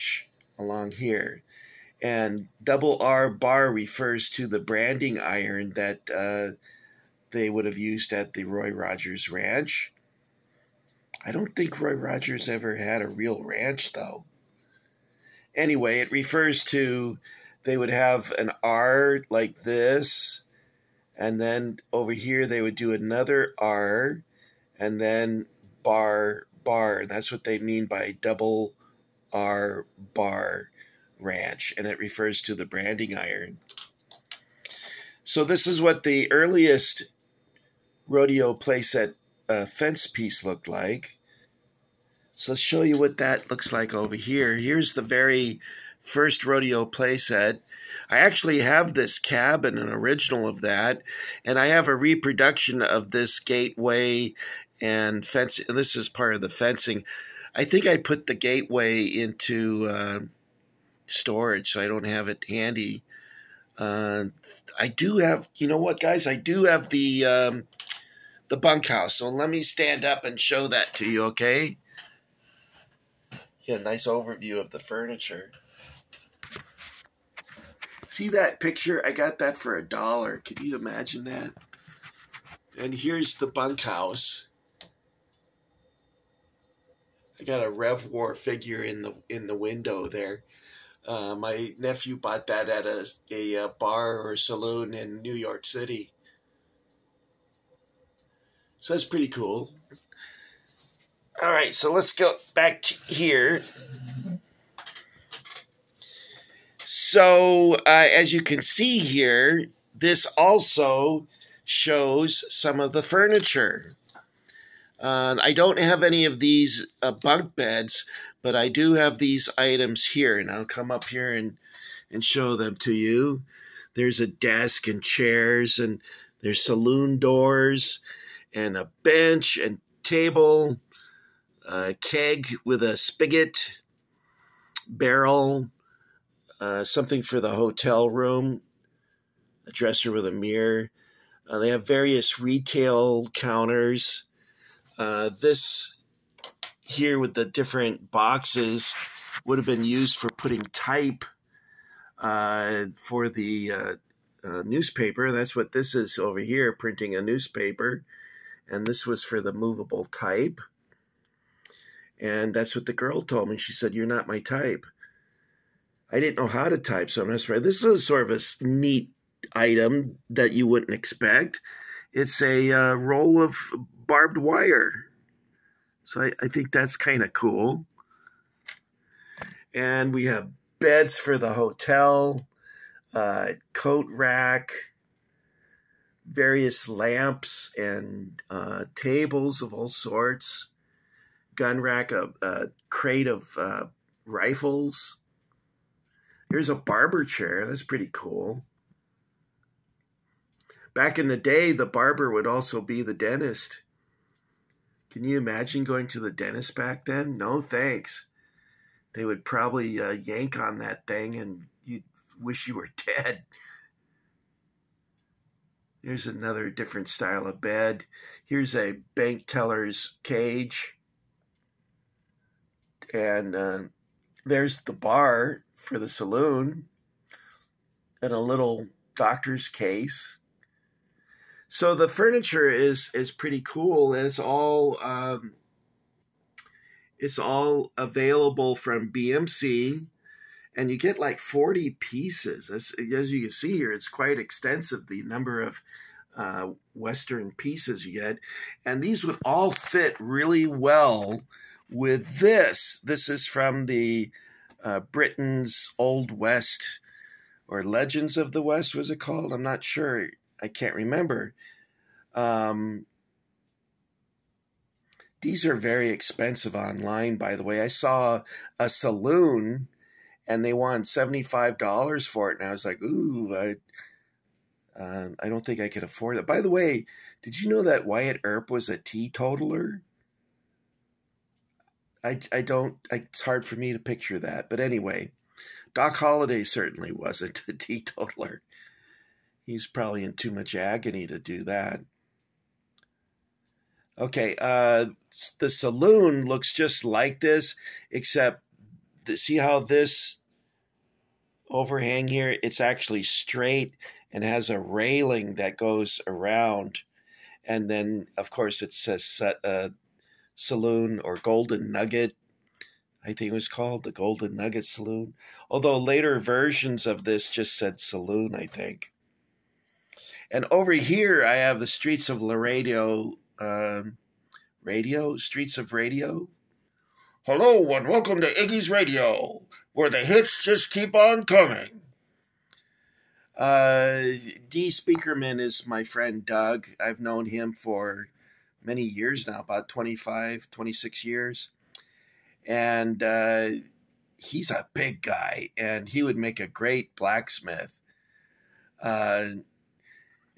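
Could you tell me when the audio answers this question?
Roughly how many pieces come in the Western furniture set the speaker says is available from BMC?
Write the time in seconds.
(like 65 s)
241 s.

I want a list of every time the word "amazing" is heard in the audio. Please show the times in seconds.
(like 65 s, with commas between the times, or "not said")
not said.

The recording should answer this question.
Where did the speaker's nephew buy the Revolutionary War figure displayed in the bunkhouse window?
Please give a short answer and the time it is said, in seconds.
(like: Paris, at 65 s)
New York City, at 95 s.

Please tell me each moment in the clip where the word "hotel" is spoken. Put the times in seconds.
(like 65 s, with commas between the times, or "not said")
137 s, 181 s.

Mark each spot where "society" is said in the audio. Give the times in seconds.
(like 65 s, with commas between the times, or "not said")
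not said.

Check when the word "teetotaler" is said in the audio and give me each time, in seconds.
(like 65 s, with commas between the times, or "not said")
278 s, 287 s.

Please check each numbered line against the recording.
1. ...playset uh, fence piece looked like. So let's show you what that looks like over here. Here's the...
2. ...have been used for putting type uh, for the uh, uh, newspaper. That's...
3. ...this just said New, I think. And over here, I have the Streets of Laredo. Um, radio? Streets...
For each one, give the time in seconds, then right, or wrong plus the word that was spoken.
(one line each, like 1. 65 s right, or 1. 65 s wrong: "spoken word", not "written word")
1. 38 s right
2. 149 s right
3. 317 s wrong: "Saloon", not "New".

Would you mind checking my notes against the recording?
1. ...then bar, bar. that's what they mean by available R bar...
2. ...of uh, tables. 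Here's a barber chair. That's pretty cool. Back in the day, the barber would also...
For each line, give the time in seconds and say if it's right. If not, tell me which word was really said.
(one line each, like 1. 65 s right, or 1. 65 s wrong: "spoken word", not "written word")
1. 24 s wrong: "double", not "available"
2. 193 s wrong: "rifles", not "tables".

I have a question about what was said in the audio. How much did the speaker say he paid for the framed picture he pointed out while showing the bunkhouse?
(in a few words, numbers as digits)
$1.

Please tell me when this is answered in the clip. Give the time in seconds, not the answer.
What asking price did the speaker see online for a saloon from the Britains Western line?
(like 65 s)
271 s.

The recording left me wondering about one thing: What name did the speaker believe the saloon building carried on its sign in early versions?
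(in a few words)
Golden Nugget Saloon.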